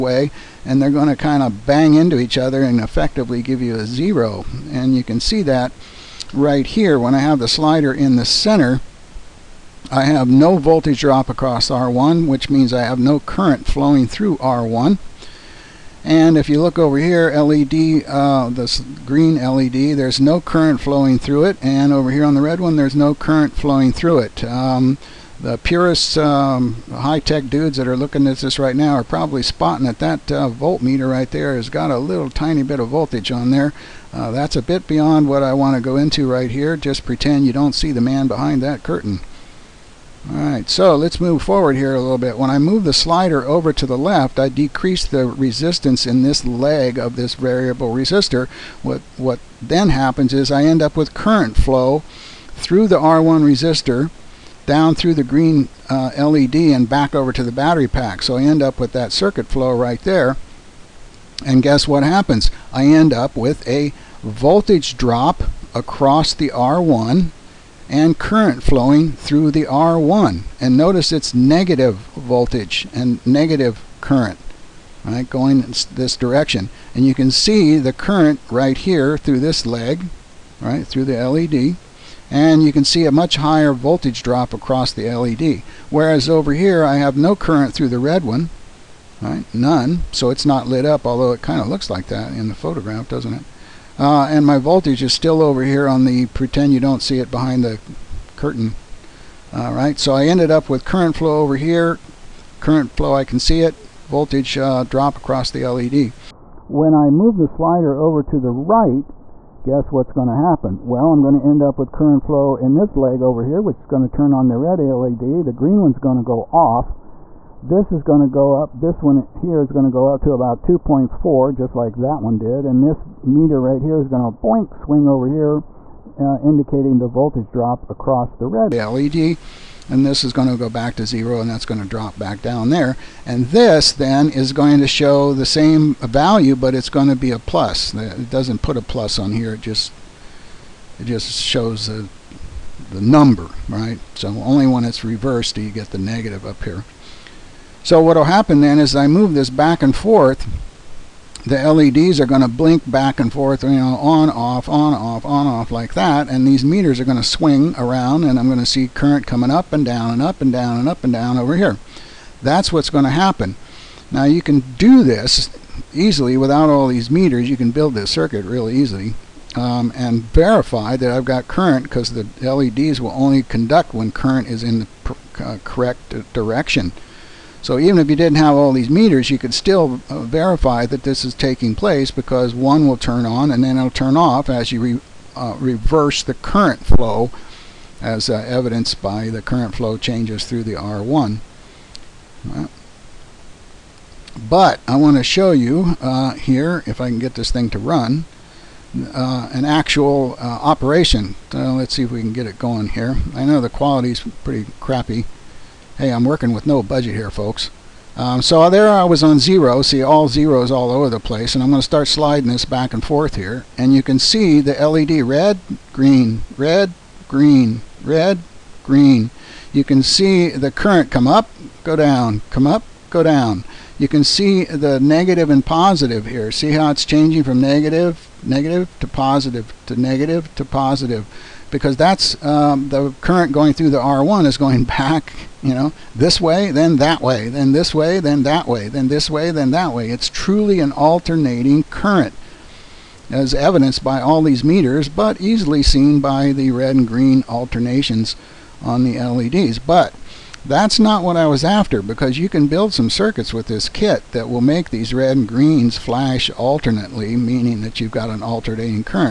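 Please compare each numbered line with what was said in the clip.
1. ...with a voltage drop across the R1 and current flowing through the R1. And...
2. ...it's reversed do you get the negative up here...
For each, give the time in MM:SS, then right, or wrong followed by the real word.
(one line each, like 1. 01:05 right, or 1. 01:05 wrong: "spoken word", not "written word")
1. 01:03 right
2. 02:24 right.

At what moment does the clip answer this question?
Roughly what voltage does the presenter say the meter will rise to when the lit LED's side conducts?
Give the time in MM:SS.
02:00.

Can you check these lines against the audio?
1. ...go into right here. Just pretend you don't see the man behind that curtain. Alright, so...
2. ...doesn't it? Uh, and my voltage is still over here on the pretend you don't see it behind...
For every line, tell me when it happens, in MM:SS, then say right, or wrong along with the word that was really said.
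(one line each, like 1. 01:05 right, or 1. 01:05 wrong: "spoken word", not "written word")
1. 00:35 right
2. 01:33 right.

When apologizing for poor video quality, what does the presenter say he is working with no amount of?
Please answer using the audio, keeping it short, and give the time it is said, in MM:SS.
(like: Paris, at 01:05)
Budget, at 03:26.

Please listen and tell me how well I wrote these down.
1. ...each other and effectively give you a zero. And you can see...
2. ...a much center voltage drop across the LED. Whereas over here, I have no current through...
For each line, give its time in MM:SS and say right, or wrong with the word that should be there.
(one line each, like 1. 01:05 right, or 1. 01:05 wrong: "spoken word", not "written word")
1. 00:02 right
2. 01:23 wrong: "higher", not "center".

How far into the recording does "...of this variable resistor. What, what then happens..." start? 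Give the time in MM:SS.
00:46.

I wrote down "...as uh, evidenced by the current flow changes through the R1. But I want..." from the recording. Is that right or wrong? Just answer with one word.
right.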